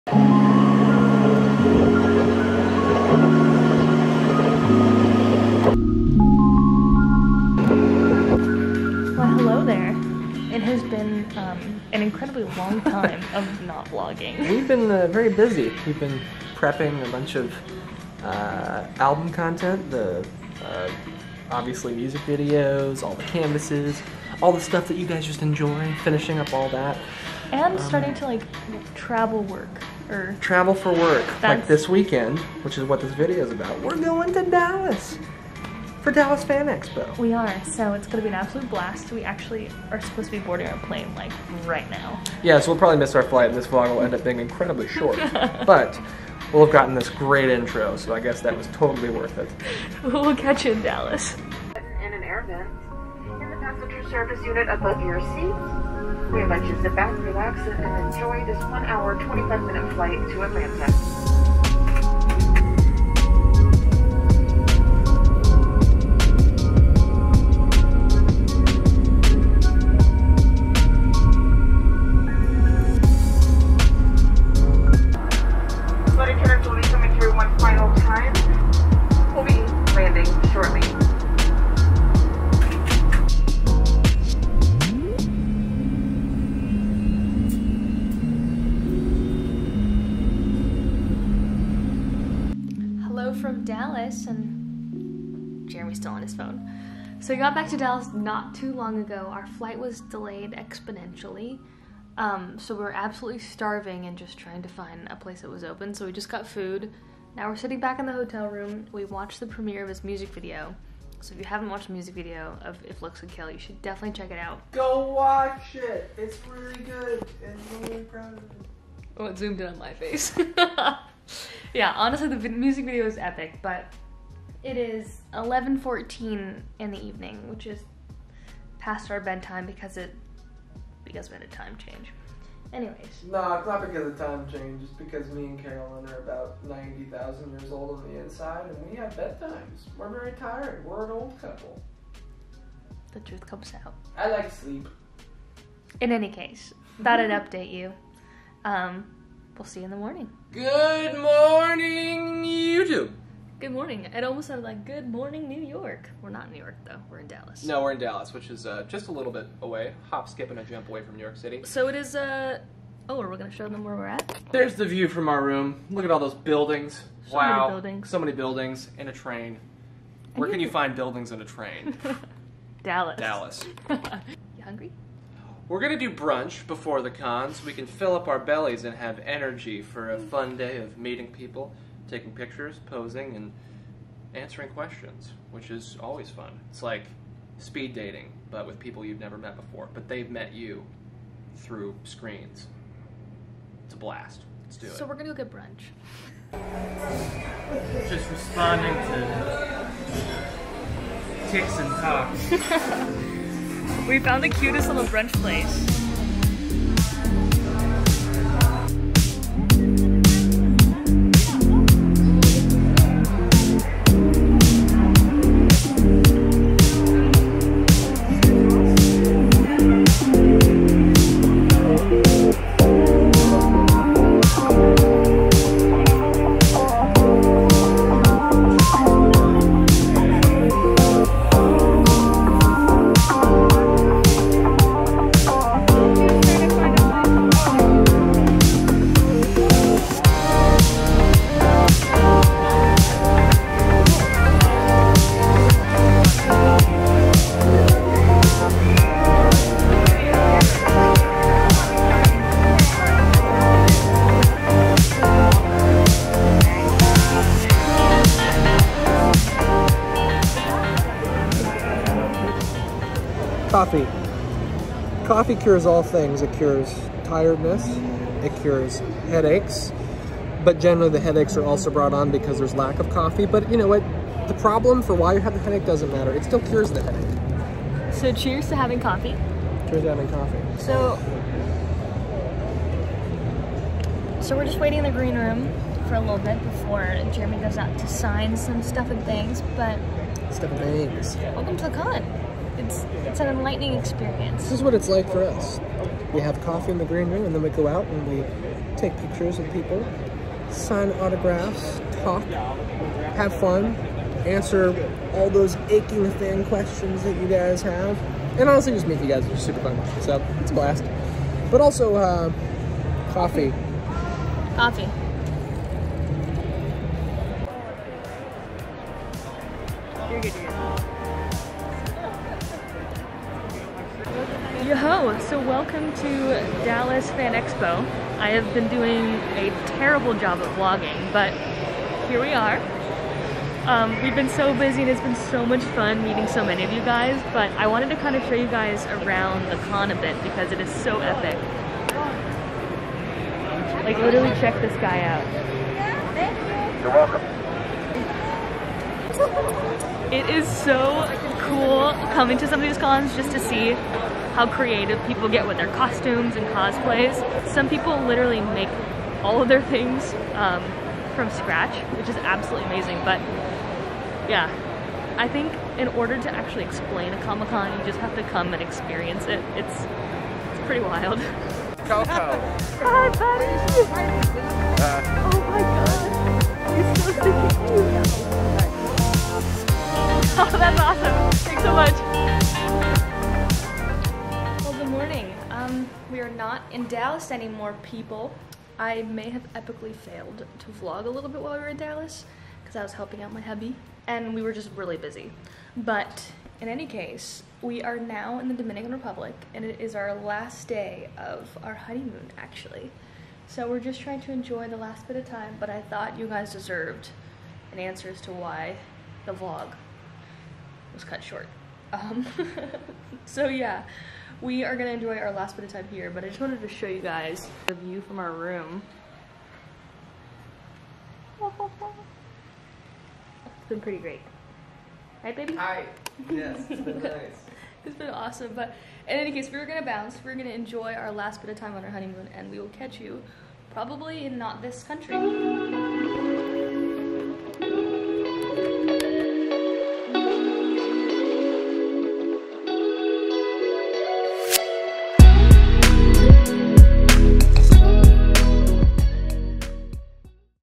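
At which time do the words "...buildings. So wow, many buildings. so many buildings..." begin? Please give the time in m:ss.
2:46.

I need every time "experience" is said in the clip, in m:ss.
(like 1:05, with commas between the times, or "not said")
4:53, 6:08.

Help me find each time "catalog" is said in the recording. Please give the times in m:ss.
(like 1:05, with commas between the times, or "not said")
not said.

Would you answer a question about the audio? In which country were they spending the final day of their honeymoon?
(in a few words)
Dominican Republic.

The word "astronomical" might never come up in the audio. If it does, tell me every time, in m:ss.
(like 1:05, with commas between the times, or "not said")
not said.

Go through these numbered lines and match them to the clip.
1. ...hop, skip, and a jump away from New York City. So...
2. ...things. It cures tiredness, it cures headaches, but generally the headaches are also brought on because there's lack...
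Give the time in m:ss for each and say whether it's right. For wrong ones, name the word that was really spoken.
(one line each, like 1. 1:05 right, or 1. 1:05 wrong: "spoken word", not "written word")
1. 2:40 right
2. 4:26 right.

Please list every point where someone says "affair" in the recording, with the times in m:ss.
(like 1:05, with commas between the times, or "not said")
not said.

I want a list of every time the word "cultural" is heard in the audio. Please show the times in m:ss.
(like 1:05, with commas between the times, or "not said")
not said.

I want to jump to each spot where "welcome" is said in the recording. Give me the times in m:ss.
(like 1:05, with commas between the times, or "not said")
4:51, 5:25, 5:47.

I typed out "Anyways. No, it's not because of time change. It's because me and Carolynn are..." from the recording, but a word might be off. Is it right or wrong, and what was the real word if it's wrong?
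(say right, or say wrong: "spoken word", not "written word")
right.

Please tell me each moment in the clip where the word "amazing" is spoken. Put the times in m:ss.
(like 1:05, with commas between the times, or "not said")
6:02.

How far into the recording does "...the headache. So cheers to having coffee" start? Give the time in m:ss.
4:36.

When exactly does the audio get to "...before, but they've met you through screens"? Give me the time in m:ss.
3:09.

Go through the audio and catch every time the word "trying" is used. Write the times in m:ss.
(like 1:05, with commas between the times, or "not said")
1:44, 6:44.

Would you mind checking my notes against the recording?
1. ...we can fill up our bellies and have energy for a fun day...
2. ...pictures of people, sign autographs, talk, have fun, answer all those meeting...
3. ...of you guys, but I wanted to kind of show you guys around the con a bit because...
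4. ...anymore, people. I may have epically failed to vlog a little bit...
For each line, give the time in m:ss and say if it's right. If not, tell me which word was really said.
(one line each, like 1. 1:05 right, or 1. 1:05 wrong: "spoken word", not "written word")
1. 2:57 right
2. 4:59 wrong: "aching", not "meeting"
3. 5:36 right
4. 6:27 right.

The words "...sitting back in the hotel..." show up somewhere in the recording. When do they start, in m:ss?
1:47.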